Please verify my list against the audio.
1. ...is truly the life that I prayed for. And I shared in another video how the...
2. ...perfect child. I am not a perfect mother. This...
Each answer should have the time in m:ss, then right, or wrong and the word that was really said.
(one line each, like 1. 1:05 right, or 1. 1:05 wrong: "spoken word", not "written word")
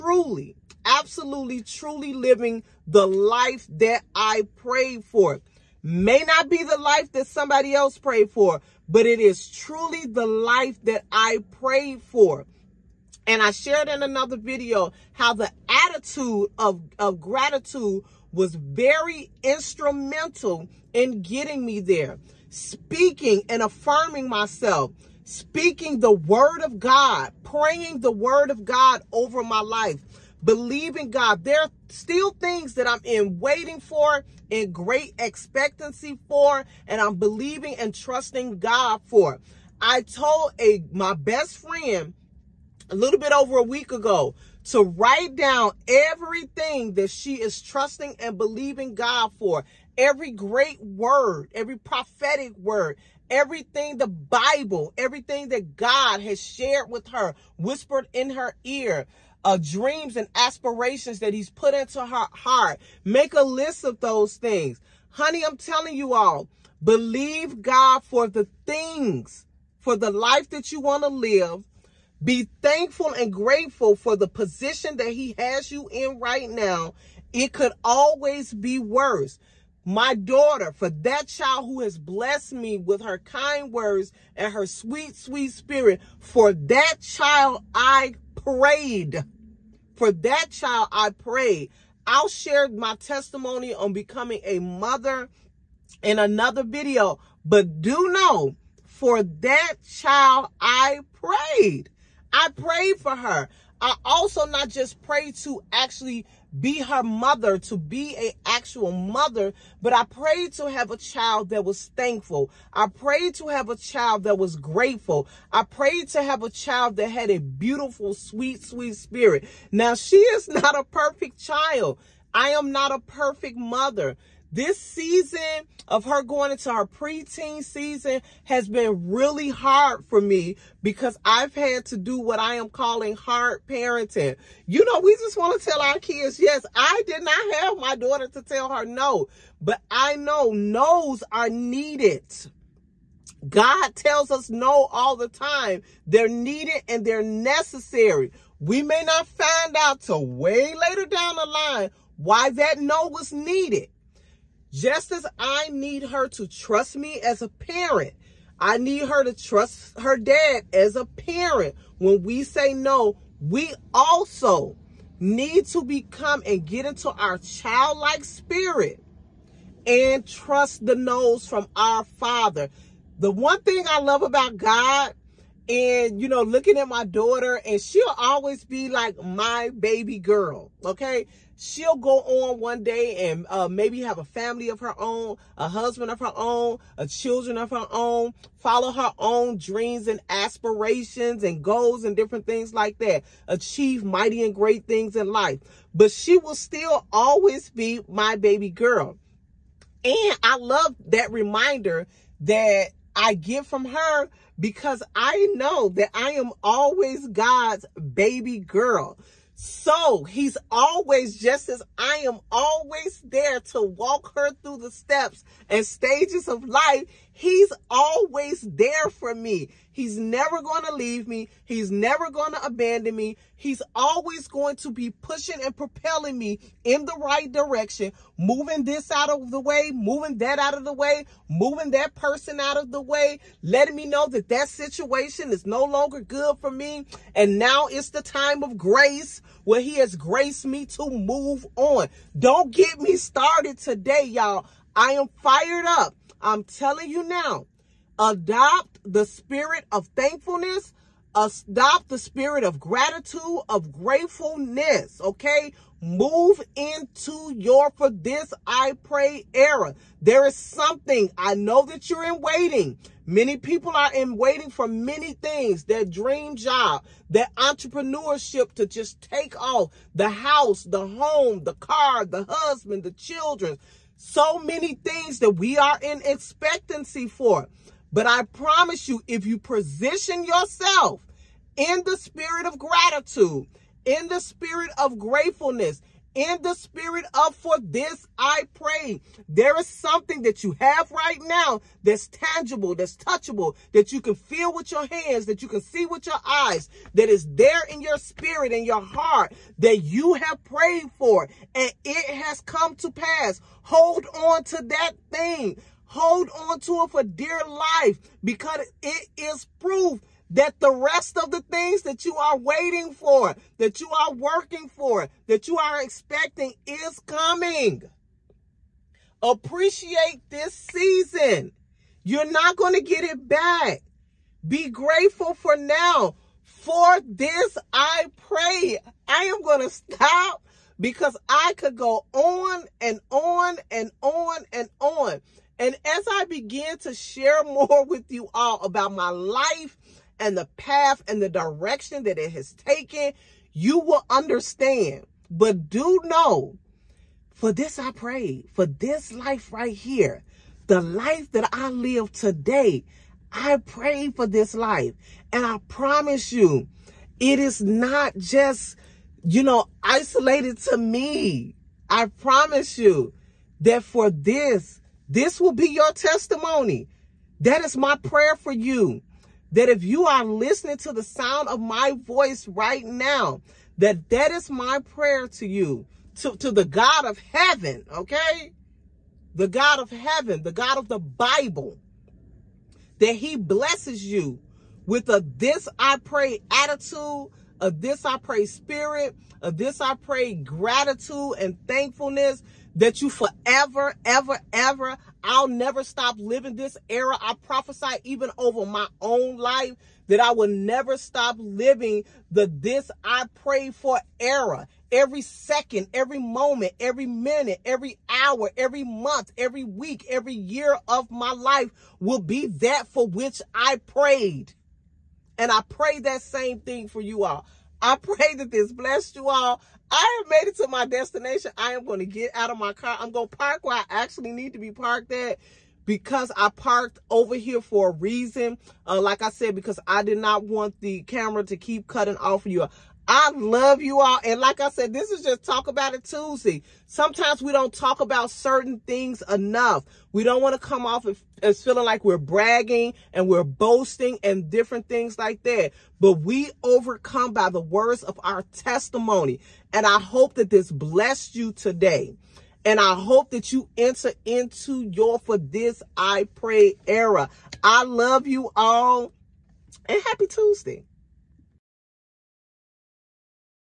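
1. 0:09 right
2. 2:00 right.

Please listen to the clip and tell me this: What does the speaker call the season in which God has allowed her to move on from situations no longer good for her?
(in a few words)
The time of grace.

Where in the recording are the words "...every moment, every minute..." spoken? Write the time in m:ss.
6:46.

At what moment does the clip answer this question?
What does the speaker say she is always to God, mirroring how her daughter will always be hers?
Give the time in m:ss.
3:27.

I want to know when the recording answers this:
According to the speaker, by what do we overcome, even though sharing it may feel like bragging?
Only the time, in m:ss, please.
7:27.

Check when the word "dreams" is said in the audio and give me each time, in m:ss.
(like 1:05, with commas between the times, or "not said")
0:59, 3:09, 4:26.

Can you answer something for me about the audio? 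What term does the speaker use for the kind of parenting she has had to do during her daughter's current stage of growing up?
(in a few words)
Hard parenting.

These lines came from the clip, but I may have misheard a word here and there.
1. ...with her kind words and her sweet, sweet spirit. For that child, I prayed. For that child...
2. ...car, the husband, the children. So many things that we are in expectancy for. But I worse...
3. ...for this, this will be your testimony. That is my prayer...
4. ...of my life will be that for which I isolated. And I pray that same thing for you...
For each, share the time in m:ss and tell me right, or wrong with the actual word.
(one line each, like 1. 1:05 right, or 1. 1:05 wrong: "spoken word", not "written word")
1. 1:22 right
2. 4:31 wrong: "promise", not "worse"
3. 6:04 right
4. 6:51 wrong: "prayed", not "isolated".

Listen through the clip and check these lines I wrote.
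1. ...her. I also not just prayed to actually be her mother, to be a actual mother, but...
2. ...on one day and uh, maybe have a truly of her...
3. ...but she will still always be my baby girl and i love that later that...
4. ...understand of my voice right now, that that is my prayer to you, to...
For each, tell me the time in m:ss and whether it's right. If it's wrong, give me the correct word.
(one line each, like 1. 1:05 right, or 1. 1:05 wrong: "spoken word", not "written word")
1. 1:43 right
2. 3:02 wrong: "family", not "truly"
3. 3:15 wrong: "reminder", not "later"
4. 6:11 wrong: "sound", not "understand".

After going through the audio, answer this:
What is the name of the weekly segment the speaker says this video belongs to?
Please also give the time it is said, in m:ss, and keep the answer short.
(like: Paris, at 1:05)
Talk About It Tuesday, at 7:15.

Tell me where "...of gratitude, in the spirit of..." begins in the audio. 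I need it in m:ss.
4:42.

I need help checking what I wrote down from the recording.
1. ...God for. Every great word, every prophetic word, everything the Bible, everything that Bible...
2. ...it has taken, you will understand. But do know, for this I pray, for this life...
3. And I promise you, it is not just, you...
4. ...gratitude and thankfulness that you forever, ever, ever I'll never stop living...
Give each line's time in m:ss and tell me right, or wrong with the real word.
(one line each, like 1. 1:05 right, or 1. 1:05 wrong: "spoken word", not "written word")
1. 0:48 wrong: "God", not "Bible"
2. 5:42 right
3. 5:55 right
4. 6:30 right.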